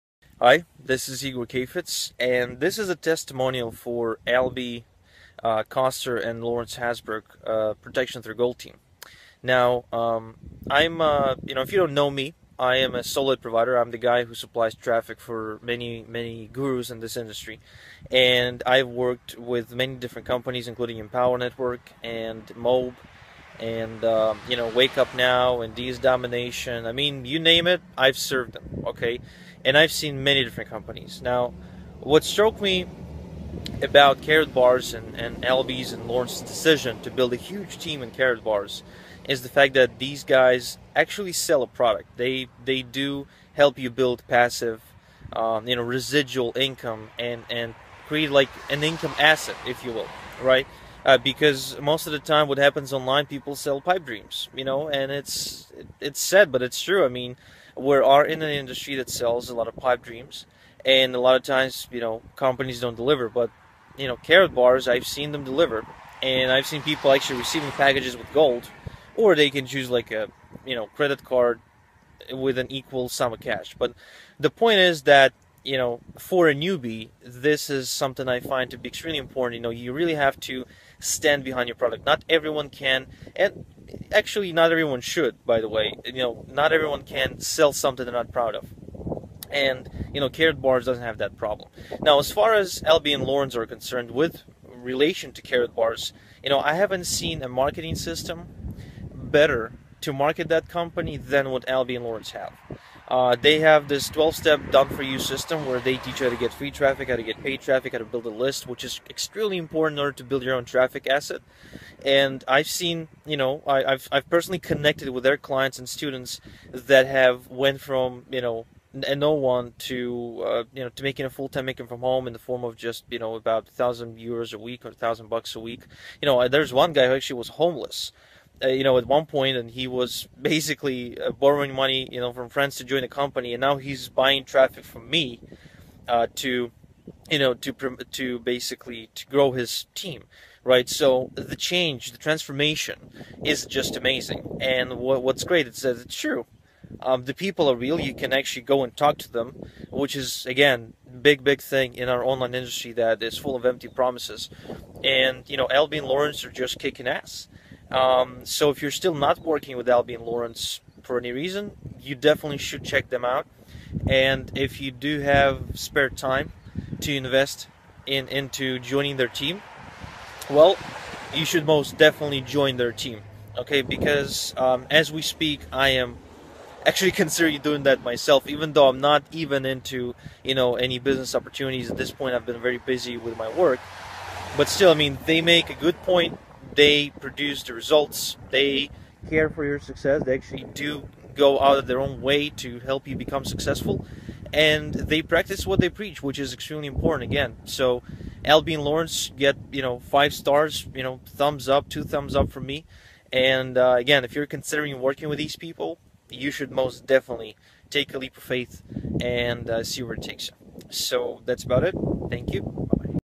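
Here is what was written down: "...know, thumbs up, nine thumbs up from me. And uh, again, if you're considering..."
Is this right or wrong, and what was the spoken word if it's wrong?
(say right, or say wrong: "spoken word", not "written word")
wrong: "two", not "nine".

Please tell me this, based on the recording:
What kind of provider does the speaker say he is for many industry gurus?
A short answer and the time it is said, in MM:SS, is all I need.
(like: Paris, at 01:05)
Solid provider, at 00:13.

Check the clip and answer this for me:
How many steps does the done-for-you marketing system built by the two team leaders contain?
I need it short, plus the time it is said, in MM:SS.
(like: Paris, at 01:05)
12, at 01:44.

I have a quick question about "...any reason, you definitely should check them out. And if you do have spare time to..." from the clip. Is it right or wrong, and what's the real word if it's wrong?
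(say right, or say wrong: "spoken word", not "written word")
right.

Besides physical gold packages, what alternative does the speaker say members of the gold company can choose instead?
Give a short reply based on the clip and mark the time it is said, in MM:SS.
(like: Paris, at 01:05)
Credit card, at 01:10.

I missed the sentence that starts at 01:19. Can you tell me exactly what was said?
You know, you really have to stand behind your product.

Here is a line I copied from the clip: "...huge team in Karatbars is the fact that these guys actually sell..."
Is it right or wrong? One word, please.
right.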